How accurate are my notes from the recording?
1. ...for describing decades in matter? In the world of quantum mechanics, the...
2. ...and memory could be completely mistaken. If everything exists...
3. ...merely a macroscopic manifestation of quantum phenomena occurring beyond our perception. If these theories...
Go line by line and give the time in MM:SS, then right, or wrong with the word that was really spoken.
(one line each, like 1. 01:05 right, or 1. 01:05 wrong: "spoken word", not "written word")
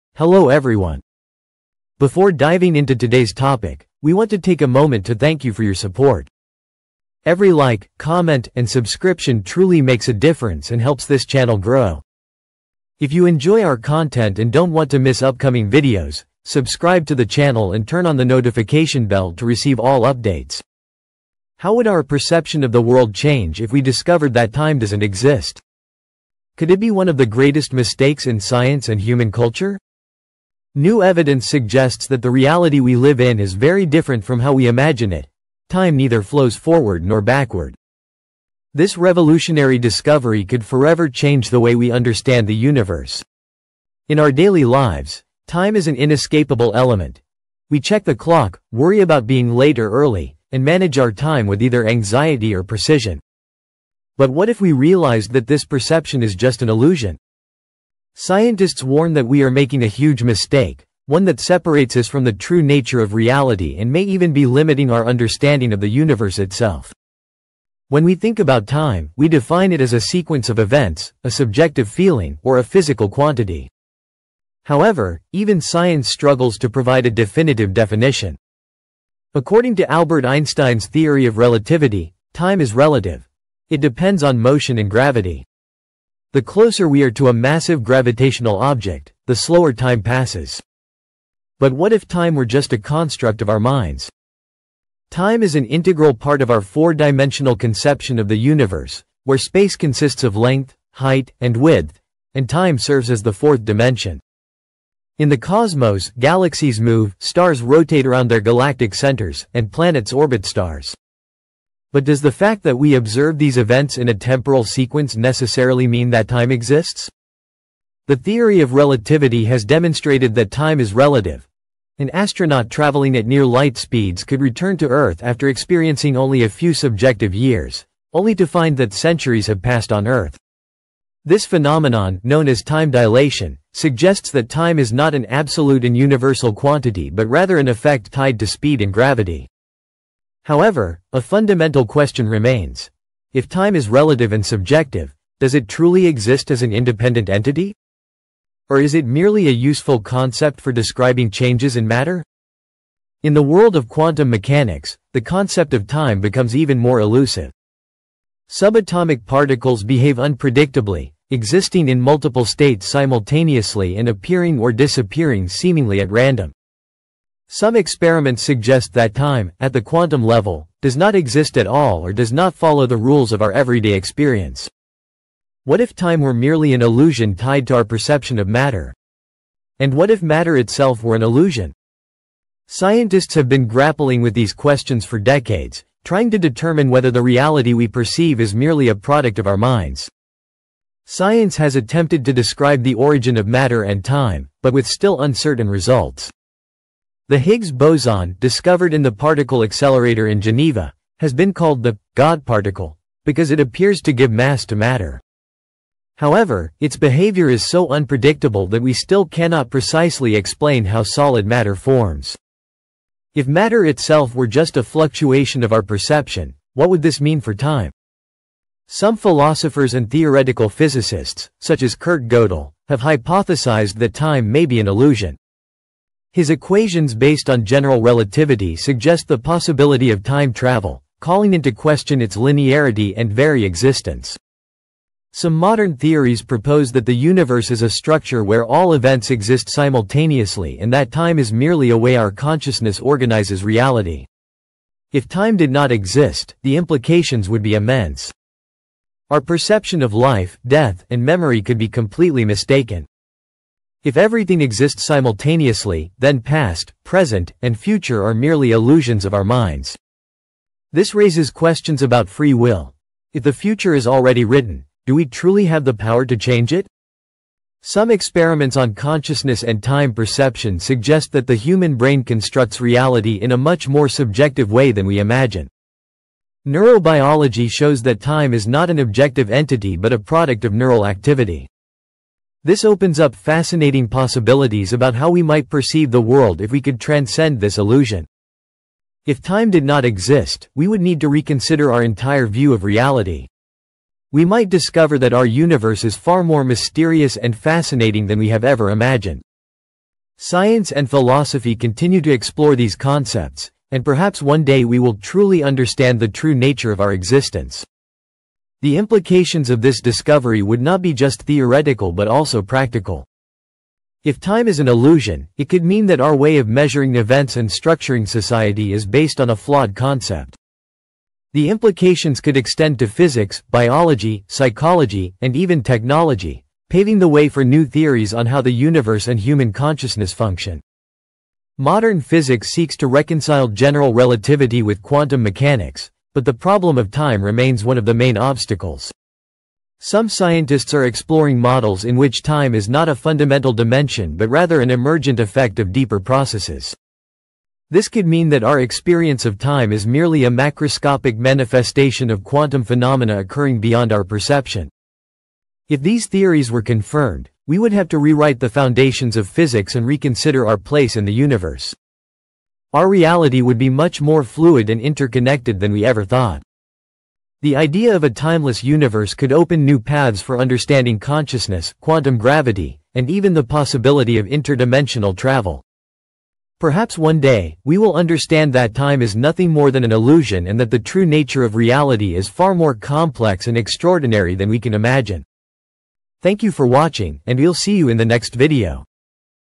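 1. 02:30 wrong: "changes", not "decades"
2. 04:11 right
3. 05:50 right.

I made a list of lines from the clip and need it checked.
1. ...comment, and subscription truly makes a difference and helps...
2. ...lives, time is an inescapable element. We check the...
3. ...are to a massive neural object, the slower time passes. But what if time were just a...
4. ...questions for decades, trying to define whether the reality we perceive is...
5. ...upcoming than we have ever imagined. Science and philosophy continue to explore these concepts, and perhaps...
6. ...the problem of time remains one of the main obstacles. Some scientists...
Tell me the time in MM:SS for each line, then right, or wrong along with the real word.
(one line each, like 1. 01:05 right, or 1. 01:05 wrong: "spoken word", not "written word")
1. 00:07 right
2. 00:44 right
3. 01:27 wrong: "gravitational", not "neural"
4. 03:04 wrong: "determine", not "define"
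5. 04:57 wrong: "fascinating", not "upcoming"
6. 05:36 right.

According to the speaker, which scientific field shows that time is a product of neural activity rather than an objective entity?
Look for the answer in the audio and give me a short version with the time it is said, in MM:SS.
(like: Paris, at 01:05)
Neurobiology, at 04:36.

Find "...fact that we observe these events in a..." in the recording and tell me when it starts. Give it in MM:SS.
01:52.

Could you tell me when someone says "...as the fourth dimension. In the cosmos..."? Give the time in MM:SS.
01:43.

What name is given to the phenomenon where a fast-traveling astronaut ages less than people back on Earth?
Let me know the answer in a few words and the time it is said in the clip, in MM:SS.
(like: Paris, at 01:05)
time dilation, at 02:12.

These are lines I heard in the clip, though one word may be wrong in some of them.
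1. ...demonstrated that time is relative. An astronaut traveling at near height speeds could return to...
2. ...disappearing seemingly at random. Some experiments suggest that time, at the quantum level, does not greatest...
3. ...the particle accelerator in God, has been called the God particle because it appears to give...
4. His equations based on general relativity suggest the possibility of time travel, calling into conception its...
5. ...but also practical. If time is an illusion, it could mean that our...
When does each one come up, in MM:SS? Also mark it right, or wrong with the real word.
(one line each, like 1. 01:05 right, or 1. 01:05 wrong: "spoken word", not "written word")
1. 01:59 wrong: "light", not "height"
2. 02:44 wrong: "exist", not "greatest"
3. 03:19 wrong: "Geneva", not "God"
4. 03:46 wrong: "question", not "conception"
5. 05:12 right.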